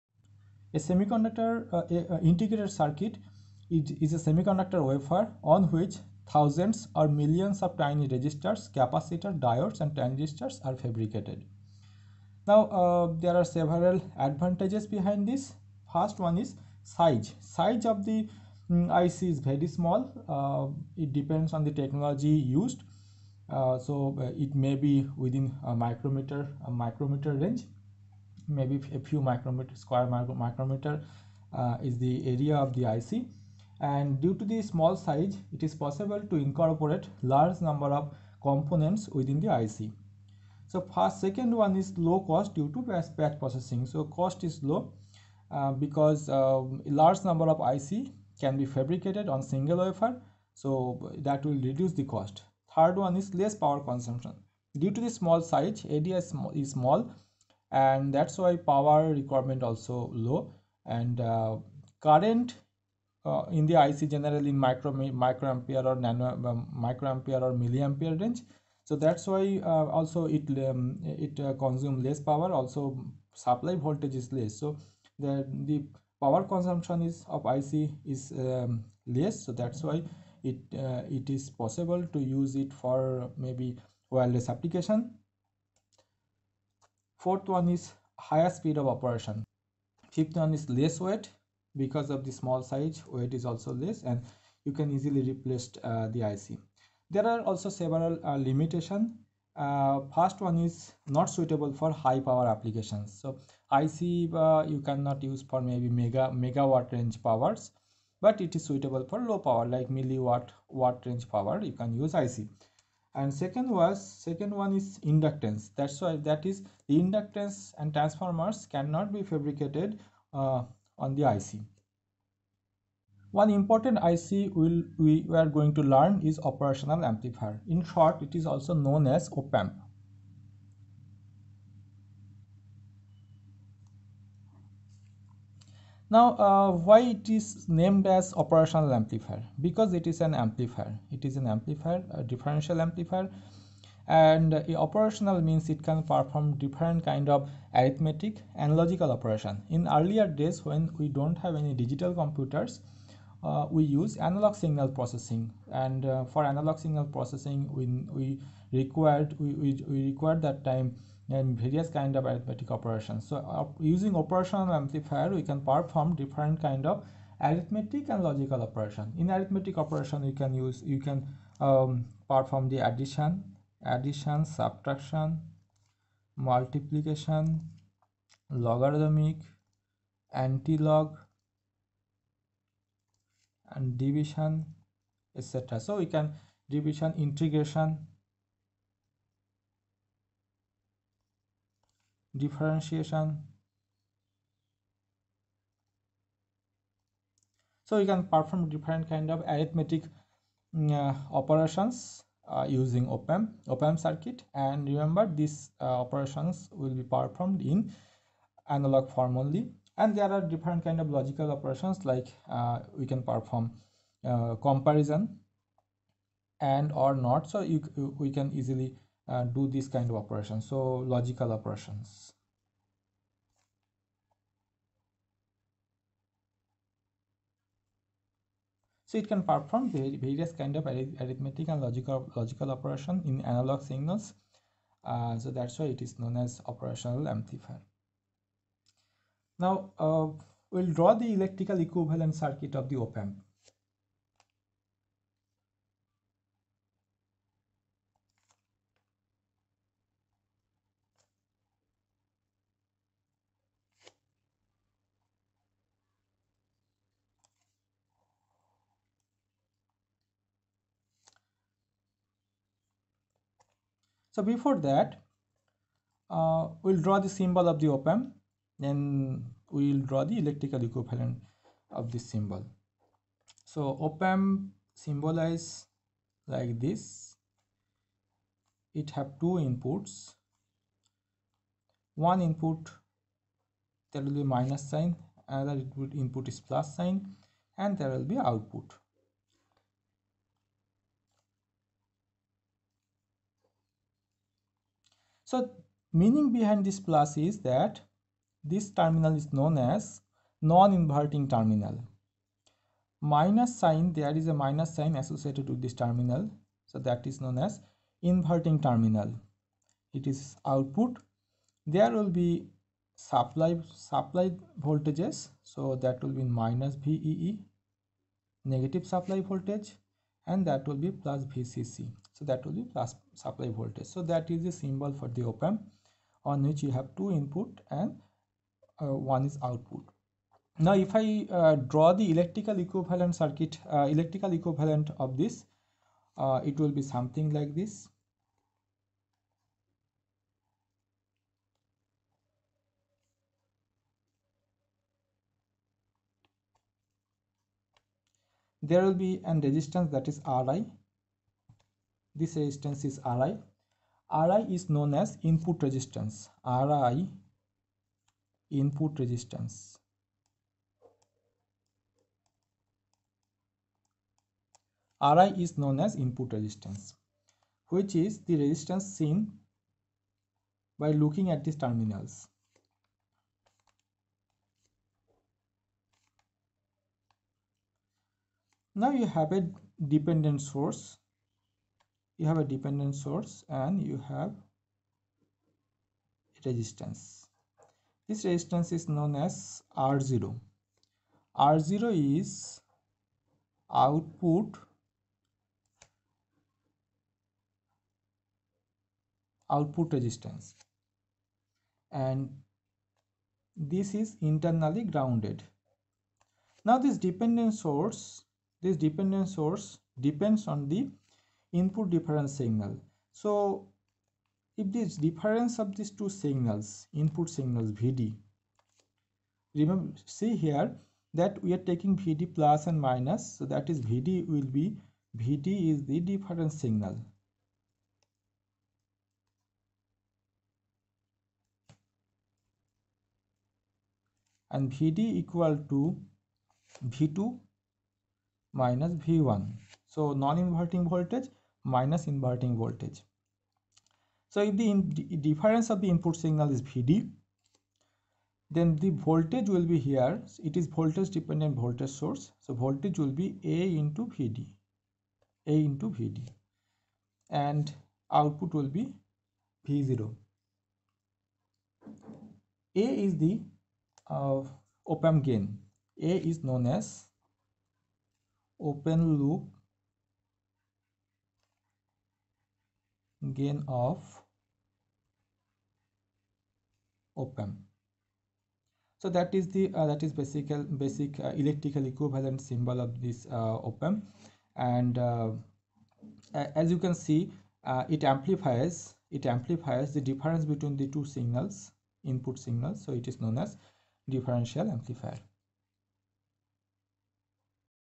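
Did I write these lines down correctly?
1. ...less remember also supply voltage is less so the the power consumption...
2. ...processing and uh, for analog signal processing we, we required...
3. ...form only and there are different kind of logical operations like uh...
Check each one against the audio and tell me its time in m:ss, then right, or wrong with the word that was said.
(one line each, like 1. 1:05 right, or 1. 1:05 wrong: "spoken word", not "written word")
1. 1:12 wrong: "power", not "remember"
2. 2:34 right
3. 3:29 right.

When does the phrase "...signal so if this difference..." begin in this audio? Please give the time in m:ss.
6:52.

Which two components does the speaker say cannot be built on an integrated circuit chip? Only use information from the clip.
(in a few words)
Inductance and transformers.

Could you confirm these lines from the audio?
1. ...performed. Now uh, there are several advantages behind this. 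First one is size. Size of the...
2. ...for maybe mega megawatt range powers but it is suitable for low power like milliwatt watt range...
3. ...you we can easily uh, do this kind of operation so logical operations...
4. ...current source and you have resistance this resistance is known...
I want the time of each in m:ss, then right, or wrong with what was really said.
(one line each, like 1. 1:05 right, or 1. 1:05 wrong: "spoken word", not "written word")
1. 0:10 wrong: "fabricated", not "performed"
2. 1:45 right
3. 3:37 right
4. 6:22 wrong: "dependent", not "current".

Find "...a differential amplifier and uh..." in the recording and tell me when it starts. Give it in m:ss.
2:22.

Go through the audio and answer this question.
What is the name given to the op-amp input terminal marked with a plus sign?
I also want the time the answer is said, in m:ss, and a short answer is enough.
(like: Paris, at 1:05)
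Non-inverting terminal, at 5:00.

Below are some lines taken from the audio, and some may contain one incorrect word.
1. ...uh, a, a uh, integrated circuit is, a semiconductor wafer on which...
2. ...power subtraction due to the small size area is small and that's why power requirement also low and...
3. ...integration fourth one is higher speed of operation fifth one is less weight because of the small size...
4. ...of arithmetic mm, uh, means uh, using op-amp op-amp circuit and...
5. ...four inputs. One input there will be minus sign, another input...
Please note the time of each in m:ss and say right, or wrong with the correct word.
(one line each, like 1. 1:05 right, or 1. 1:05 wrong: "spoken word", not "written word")
1. 0:01 right
2. 0:53 wrong: "consumption", not "subtraction"
3. 1:24 wrong: "application", not "integration"
4. 3:19 wrong: "operations", not "means"
5. 4:39 wrong: "two", not "four".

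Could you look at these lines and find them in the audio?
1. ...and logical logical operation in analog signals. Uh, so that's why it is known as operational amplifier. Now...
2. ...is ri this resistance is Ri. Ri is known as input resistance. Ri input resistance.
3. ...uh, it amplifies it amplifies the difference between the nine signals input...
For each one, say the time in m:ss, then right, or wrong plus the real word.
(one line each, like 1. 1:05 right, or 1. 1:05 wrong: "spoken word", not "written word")
1. 3:51 right
2. 5:50 right
3. 8:07 wrong: "two", not "nine".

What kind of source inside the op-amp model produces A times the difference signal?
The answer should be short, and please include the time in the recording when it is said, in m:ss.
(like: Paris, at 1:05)
Voltage dependent voltage source, at 7:30.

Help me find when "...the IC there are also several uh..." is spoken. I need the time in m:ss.
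1:36.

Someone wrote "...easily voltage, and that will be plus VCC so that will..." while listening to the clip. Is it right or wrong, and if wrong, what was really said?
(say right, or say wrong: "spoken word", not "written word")
wrong: "supply", not "easily".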